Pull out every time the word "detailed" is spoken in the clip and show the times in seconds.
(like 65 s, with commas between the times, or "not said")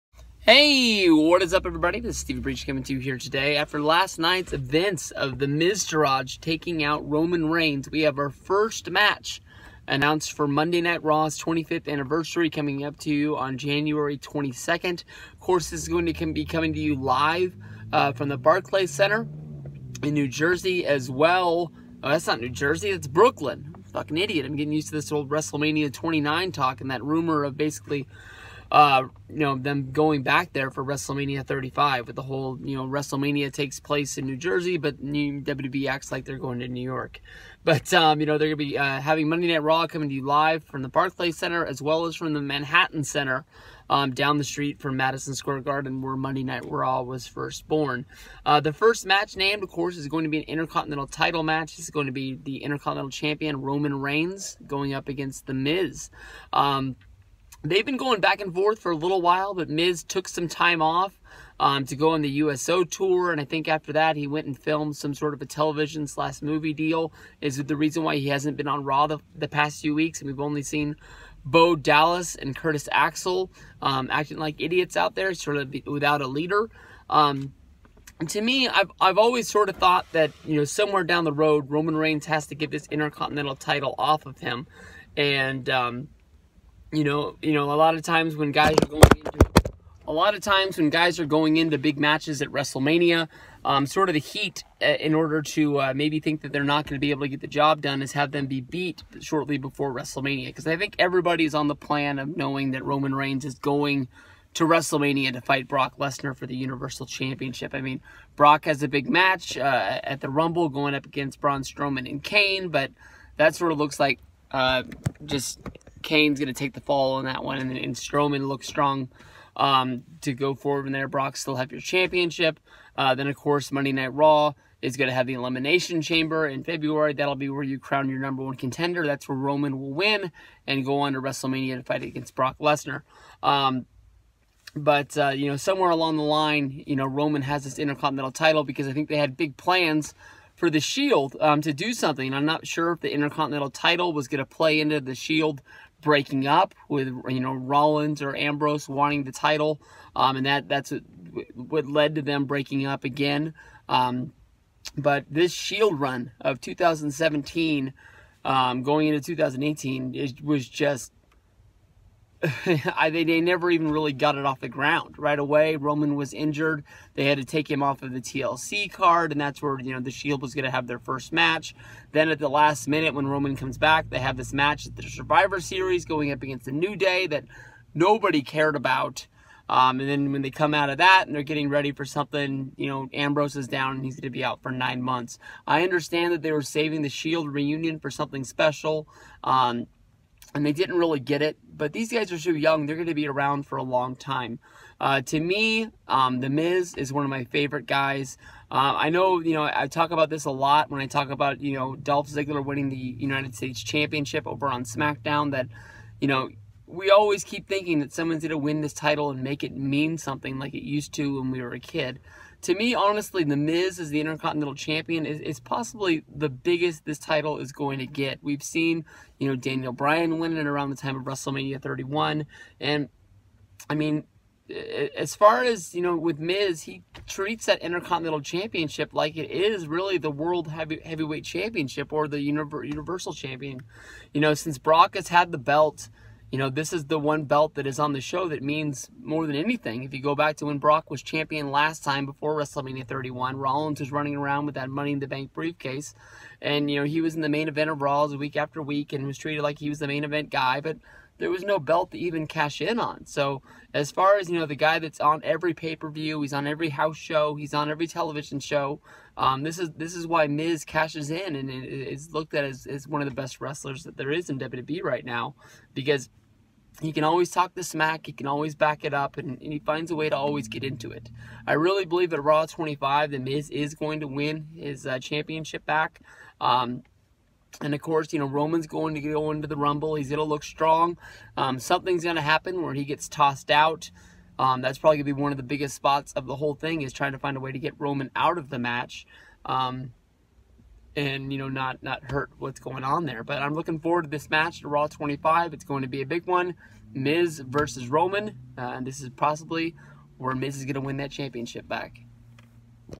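not said.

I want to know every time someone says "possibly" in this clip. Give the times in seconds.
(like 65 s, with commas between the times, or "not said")
215 s, 299 s.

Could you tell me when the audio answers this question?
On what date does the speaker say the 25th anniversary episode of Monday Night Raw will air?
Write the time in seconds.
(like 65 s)
13 s.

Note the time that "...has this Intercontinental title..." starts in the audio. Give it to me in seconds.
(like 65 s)
137 s.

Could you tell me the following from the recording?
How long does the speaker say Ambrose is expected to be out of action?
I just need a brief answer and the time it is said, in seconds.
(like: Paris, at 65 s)
9 months, at 184 s.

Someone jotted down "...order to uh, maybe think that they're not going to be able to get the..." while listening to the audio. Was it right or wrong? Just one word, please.
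right.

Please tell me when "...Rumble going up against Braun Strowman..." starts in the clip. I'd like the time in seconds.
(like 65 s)
110 s.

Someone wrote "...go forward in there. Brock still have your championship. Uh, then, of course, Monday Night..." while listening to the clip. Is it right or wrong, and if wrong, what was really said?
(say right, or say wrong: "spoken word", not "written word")
right.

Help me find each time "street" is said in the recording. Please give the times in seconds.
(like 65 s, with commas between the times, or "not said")
44 s.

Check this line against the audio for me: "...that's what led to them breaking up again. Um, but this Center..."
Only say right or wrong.
wrong.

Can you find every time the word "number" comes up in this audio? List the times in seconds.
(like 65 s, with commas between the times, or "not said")
128 s.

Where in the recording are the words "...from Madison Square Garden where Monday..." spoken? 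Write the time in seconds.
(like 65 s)
44 s.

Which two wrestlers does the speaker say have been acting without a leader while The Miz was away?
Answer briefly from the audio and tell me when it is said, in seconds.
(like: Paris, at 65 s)
Bo Dallas and Curtis Axel, at 71 s.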